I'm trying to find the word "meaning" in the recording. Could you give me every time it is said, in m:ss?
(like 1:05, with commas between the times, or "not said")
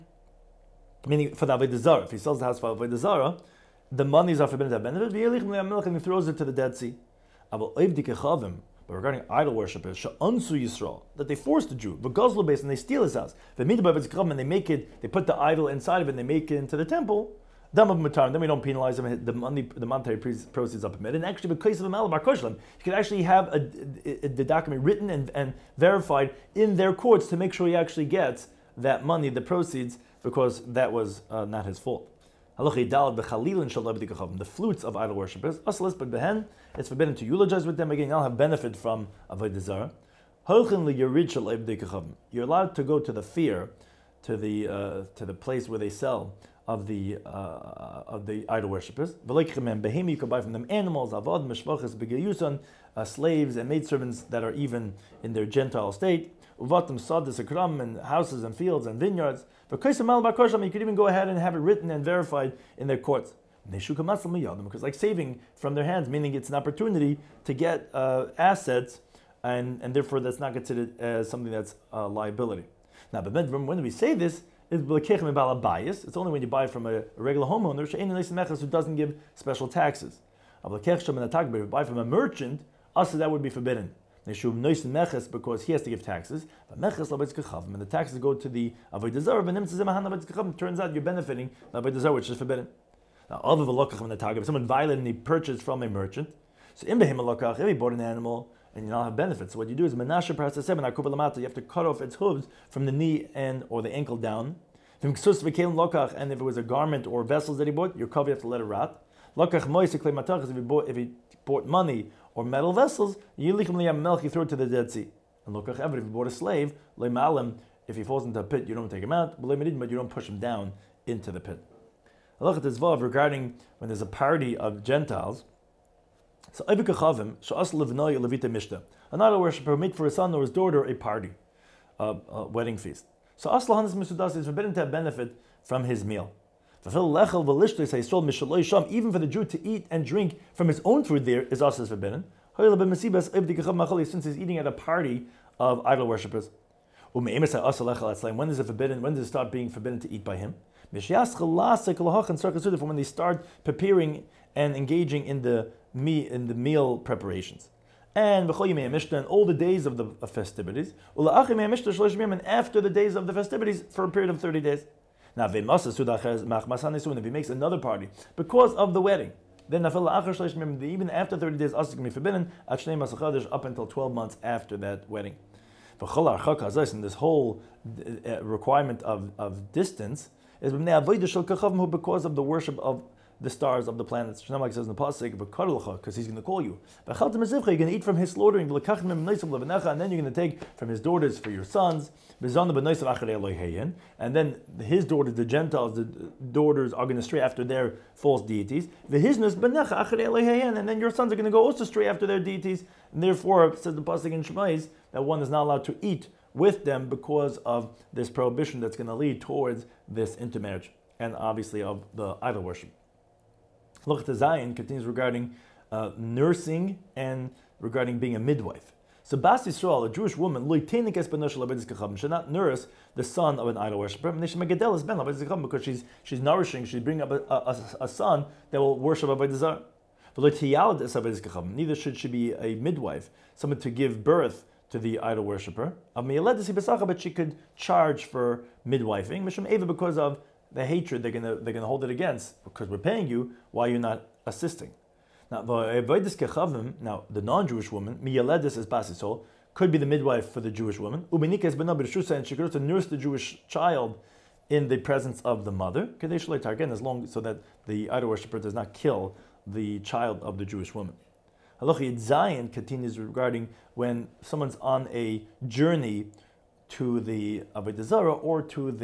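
0:01, 1:06.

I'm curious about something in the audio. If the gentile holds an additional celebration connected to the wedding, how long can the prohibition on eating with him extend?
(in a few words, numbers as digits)
12 months.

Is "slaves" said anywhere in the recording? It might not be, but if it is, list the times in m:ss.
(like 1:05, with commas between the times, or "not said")
0:53, 1:56.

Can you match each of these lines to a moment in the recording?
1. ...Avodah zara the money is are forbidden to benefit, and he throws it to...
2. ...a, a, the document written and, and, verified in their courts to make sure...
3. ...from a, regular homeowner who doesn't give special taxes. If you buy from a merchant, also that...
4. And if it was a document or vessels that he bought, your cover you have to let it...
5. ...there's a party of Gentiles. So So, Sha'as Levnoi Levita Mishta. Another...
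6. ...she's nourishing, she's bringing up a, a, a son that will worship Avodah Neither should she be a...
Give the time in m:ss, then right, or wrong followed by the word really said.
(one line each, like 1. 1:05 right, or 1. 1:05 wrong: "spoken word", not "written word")
1. 0:02 right
2. 0:24 right
3. 1:16 right
4. 1:45 wrong: "garment", not "document"
5. 2:03 right
6. 3:46 right.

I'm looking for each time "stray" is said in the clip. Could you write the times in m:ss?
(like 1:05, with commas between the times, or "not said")
3:17, 3:21.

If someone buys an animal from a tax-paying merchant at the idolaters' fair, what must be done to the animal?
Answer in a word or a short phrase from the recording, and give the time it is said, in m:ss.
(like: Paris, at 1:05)
Cut off its hooves, at 1:41.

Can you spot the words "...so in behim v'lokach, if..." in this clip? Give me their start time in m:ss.
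1:36.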